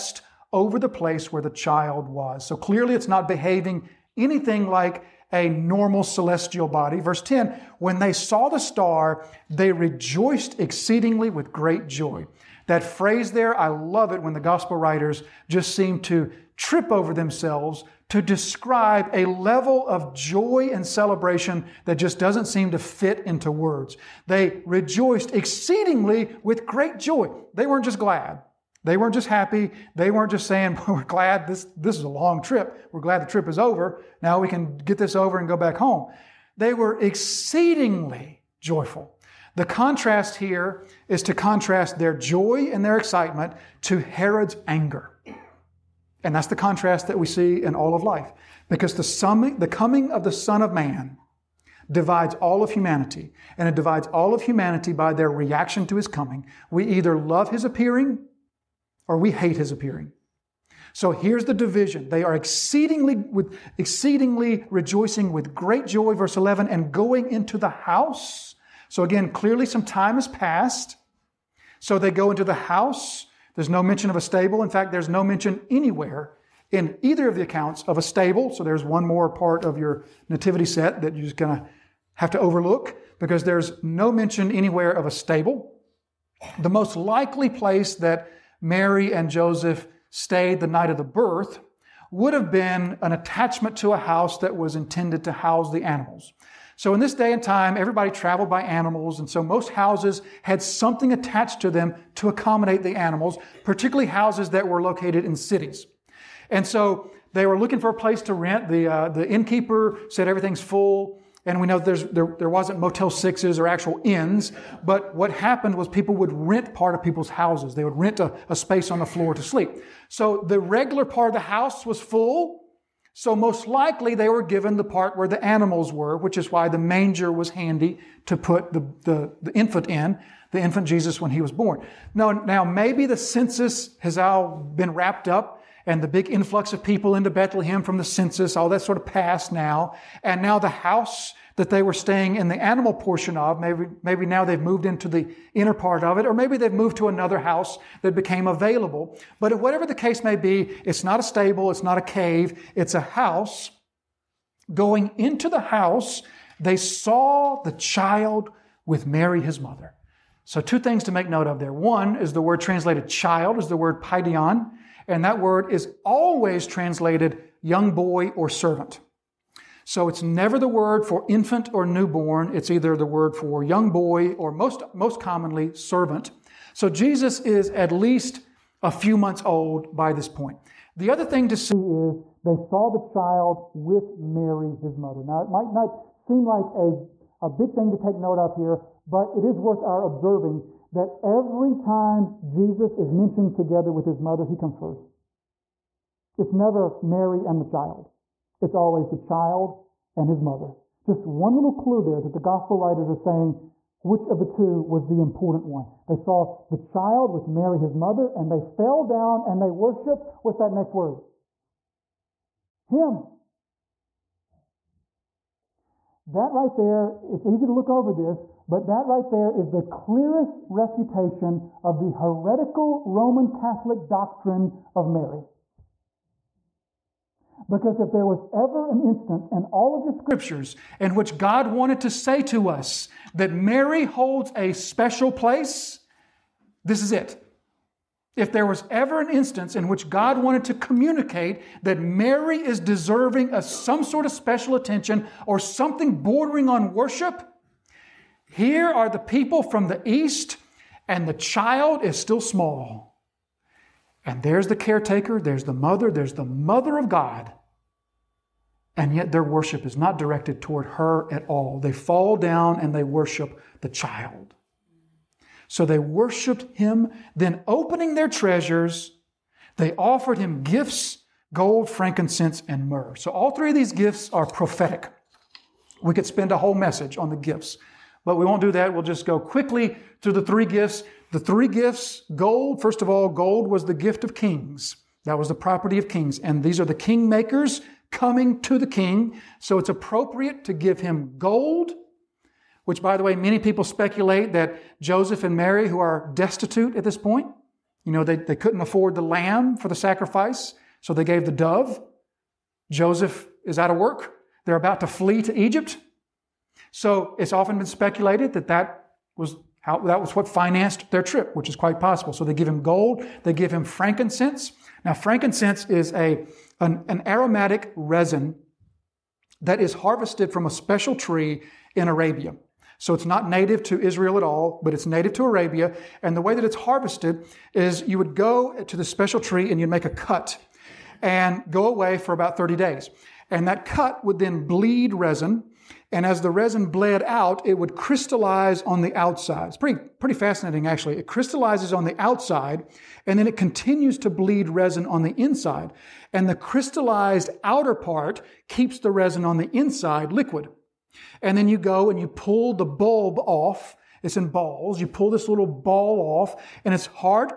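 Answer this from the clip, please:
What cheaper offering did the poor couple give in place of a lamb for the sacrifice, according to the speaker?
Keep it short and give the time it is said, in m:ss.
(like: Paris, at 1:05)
the dove, at 5:01.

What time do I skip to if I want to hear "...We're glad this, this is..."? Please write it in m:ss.
0:30.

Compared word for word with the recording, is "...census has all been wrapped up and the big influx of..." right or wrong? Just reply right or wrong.
right.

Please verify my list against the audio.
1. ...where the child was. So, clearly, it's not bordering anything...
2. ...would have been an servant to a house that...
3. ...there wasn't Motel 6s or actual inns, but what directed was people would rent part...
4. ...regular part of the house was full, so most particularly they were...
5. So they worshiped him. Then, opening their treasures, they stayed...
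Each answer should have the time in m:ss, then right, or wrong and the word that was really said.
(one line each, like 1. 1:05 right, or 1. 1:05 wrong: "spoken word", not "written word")
1. 0:01 wrong: "behaving", not "bordering"
2. 1:32 wrong: "attachment", not "servant"
3. 1:52 wrong: "happened", not "directed"
4. 2:00 wrong: "likely", not "particularly"
5. 4:25 wrong: "offered", not "stayed".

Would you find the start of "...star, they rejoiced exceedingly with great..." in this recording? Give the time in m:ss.
0:08.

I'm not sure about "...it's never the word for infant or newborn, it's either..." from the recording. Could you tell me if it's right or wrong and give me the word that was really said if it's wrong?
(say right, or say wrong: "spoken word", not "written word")
right.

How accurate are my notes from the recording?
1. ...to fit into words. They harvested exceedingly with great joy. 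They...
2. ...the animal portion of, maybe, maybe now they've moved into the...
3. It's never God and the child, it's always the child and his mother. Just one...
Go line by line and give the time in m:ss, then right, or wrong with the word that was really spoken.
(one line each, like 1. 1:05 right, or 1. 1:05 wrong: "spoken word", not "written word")
1. 0:22 wrong: "rejoiced", not "harvested"
2. 2:22 right
3. 3:16 wrong: "Mary", not "God".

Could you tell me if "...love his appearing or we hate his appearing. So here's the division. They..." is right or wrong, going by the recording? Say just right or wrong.
right.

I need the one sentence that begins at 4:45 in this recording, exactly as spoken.
That was the property of kings.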